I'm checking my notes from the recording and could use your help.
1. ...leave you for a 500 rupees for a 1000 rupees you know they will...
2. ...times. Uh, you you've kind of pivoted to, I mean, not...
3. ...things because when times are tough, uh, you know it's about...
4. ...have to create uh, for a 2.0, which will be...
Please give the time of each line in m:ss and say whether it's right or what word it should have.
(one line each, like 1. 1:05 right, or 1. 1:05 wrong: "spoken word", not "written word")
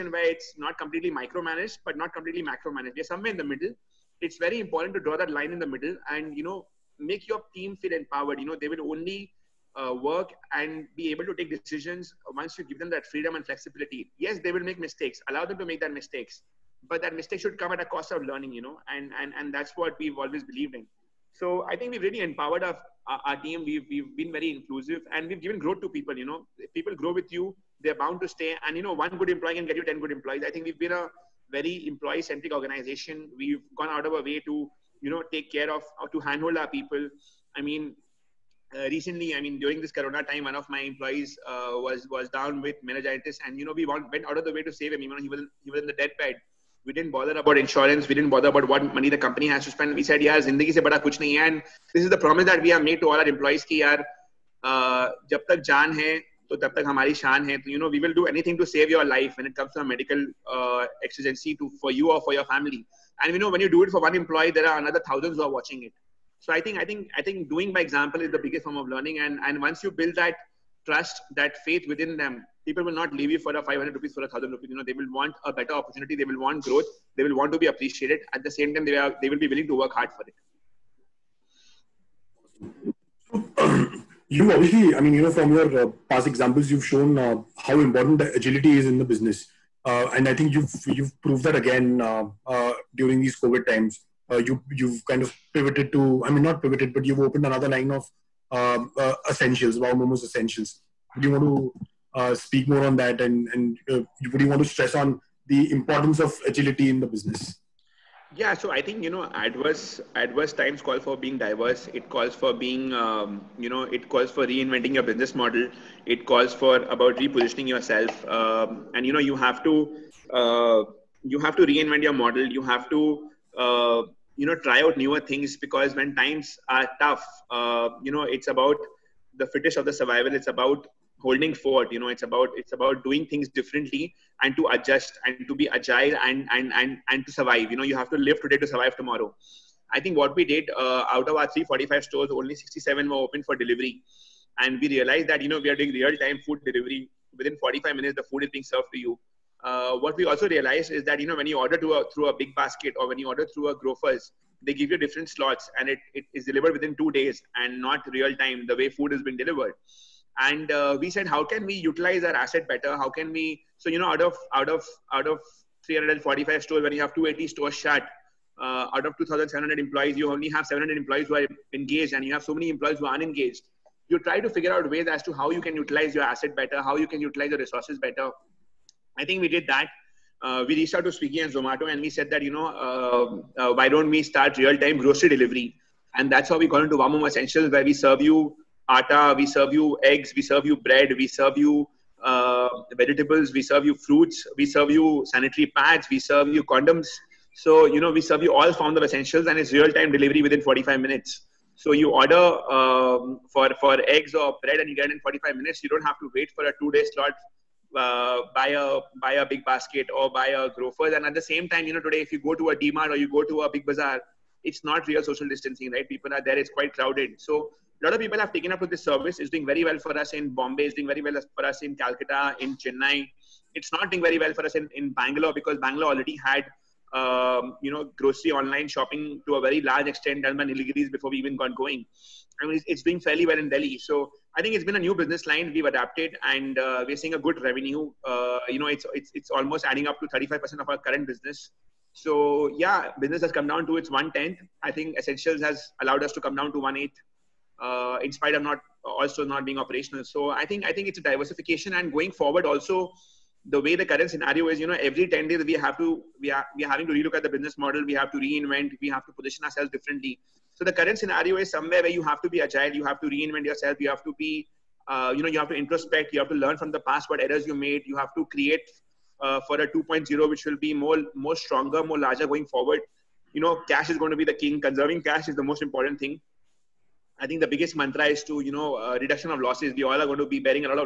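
1. 1:13 right
2. 1:33 right
3. 2:05 right
4. 4:28 right.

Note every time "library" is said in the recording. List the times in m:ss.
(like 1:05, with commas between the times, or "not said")
not said.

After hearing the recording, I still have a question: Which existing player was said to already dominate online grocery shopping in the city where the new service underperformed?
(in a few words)
Nilgiris.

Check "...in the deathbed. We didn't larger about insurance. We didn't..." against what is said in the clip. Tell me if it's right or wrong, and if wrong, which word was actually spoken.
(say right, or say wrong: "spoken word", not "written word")
wrong: "bother", not "larger".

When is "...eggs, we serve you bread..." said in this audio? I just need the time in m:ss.
3:10.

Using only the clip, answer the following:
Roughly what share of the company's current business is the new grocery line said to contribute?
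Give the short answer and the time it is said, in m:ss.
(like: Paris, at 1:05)
35%, at 4:00.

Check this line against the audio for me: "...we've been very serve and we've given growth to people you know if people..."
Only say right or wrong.
wrong.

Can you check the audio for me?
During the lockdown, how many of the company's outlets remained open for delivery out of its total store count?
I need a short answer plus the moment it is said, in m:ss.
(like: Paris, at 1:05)
67, at 2:22.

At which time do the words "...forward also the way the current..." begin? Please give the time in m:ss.
4:12.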